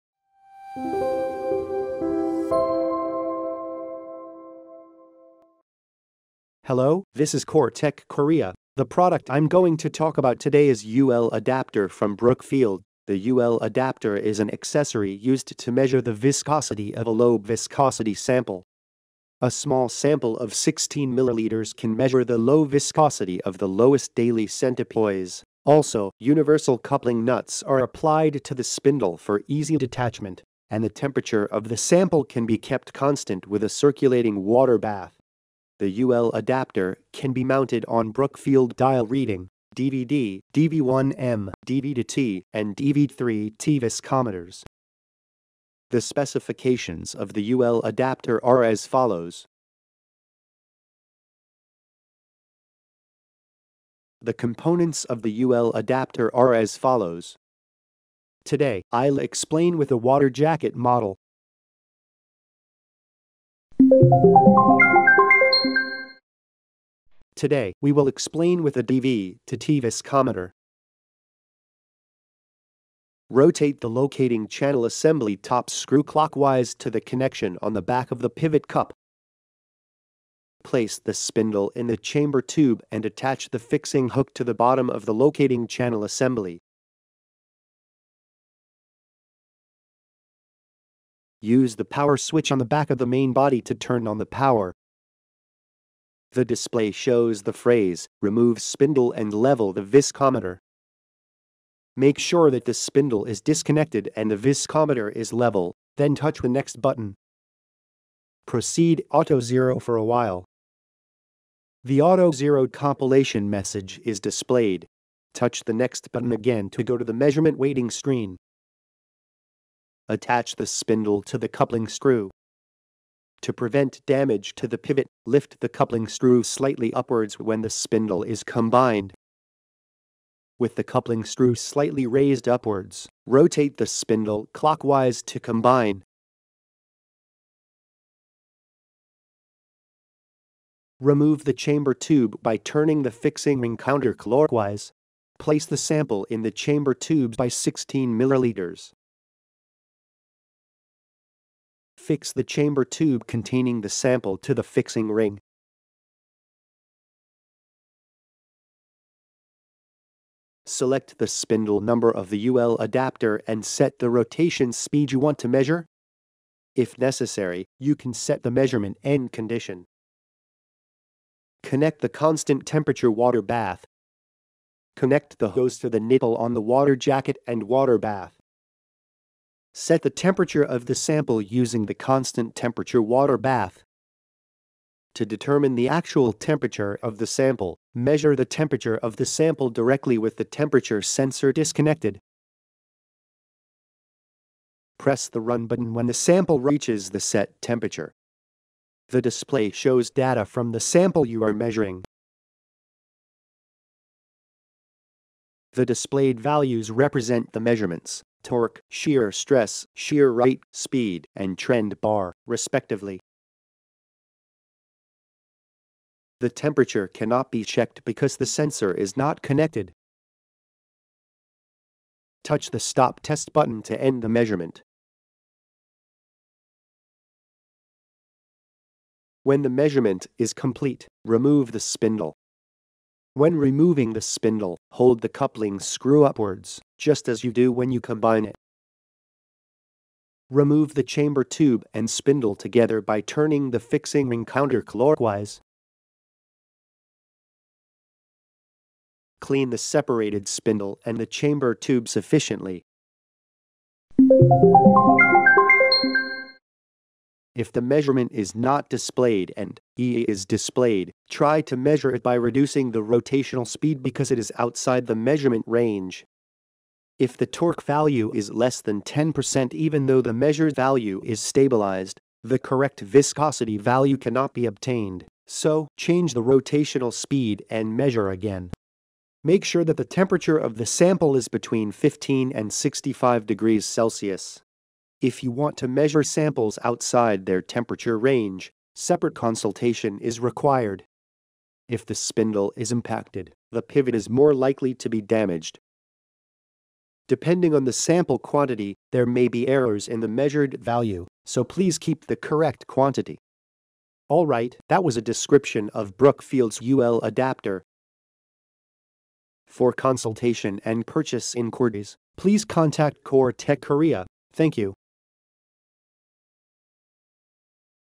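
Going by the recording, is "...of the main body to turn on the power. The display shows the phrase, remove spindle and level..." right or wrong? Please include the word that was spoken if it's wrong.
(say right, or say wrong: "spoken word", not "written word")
right.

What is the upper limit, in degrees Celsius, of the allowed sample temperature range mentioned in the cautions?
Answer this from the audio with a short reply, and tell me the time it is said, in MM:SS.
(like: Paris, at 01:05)
65, at 04:42.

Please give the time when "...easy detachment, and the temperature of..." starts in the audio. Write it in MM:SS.
00:29.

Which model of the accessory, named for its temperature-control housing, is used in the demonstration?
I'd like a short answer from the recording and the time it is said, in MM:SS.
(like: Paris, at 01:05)
water jacket model, at 00:59.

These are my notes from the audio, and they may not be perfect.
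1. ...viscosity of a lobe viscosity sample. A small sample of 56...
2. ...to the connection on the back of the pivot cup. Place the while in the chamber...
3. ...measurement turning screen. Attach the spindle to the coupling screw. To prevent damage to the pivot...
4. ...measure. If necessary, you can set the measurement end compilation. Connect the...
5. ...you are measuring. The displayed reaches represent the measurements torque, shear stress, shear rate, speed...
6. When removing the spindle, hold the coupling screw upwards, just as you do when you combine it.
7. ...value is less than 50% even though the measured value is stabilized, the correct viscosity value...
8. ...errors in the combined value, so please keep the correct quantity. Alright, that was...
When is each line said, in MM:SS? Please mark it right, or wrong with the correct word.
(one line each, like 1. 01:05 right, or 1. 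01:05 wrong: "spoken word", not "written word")
1. 00:16 wrong: "16", not "56"
2. 01:16 wrong: "spindle", not "while"
3. 01:57 wrong: "waiting", not "turning"
4. 02:45 wrong: "condition", not "compilation"
5. 03:21 wrong: "values", not "reaches"
6. 03:53 right
7. 04:27 wrong: "10", not "50"
8. 04:59 wrong: "measured", not "combined".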